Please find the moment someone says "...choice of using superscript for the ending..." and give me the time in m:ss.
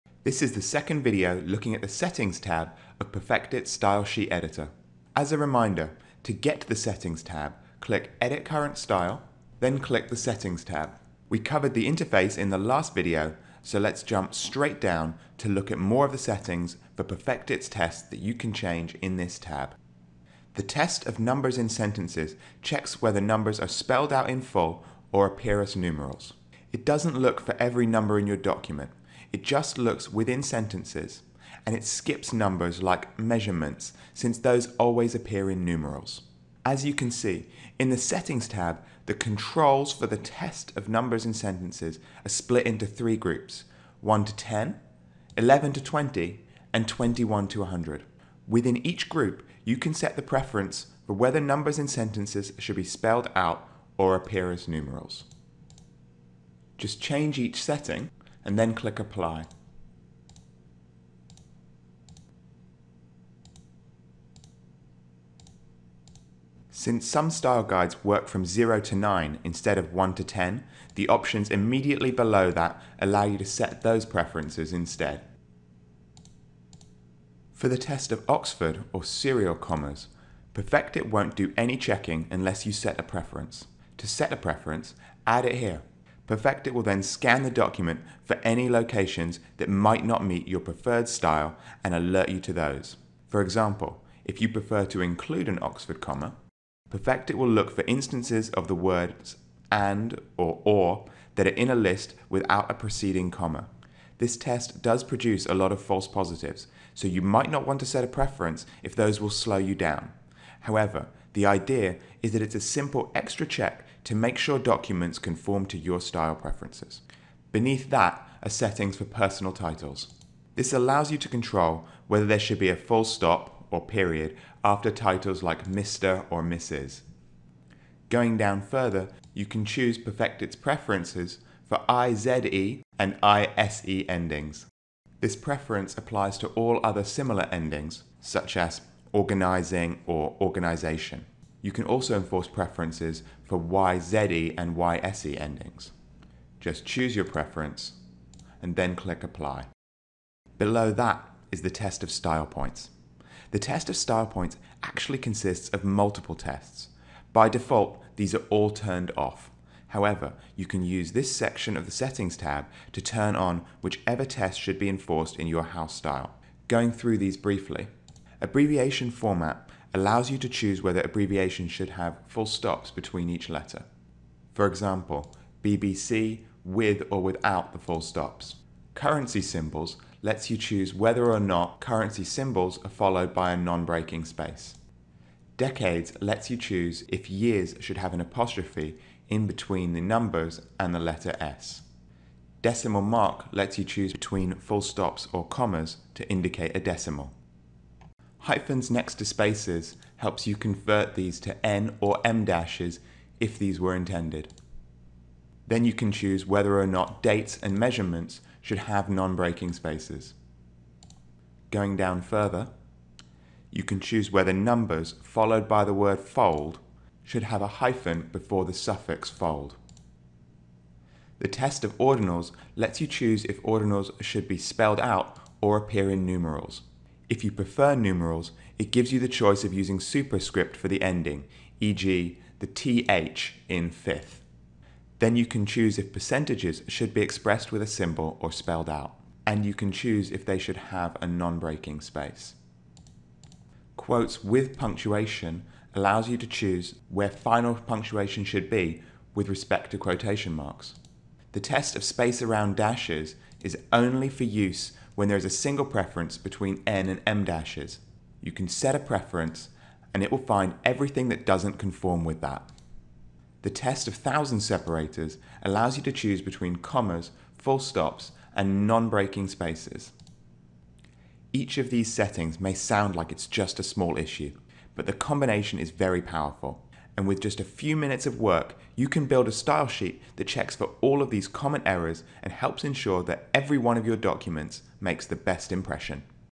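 3:49.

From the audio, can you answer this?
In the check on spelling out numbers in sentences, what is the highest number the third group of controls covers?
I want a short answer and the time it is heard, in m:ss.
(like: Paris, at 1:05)
100, at 0:46.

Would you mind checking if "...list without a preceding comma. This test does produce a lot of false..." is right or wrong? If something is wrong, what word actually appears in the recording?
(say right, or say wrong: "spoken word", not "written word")
right.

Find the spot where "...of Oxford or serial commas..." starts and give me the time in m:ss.
1:18.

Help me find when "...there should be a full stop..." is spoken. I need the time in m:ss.
2:02.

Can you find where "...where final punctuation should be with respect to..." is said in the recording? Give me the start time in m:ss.
4:07.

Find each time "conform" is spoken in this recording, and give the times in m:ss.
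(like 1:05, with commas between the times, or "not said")
1:55, 4:21.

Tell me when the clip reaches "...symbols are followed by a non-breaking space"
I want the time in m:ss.
3:02.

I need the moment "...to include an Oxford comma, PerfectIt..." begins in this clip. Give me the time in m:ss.
1:34.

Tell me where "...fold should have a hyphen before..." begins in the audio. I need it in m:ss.
3:36.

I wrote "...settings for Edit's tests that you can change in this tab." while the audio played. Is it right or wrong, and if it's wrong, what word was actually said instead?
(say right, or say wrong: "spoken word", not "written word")
wrong: "PerfectIt", not "Edit".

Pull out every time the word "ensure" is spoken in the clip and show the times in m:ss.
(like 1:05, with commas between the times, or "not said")
4:42.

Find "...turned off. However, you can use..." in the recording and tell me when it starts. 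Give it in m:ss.
2:38.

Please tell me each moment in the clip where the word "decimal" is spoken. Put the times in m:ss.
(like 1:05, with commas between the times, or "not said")
3:12, 3:16.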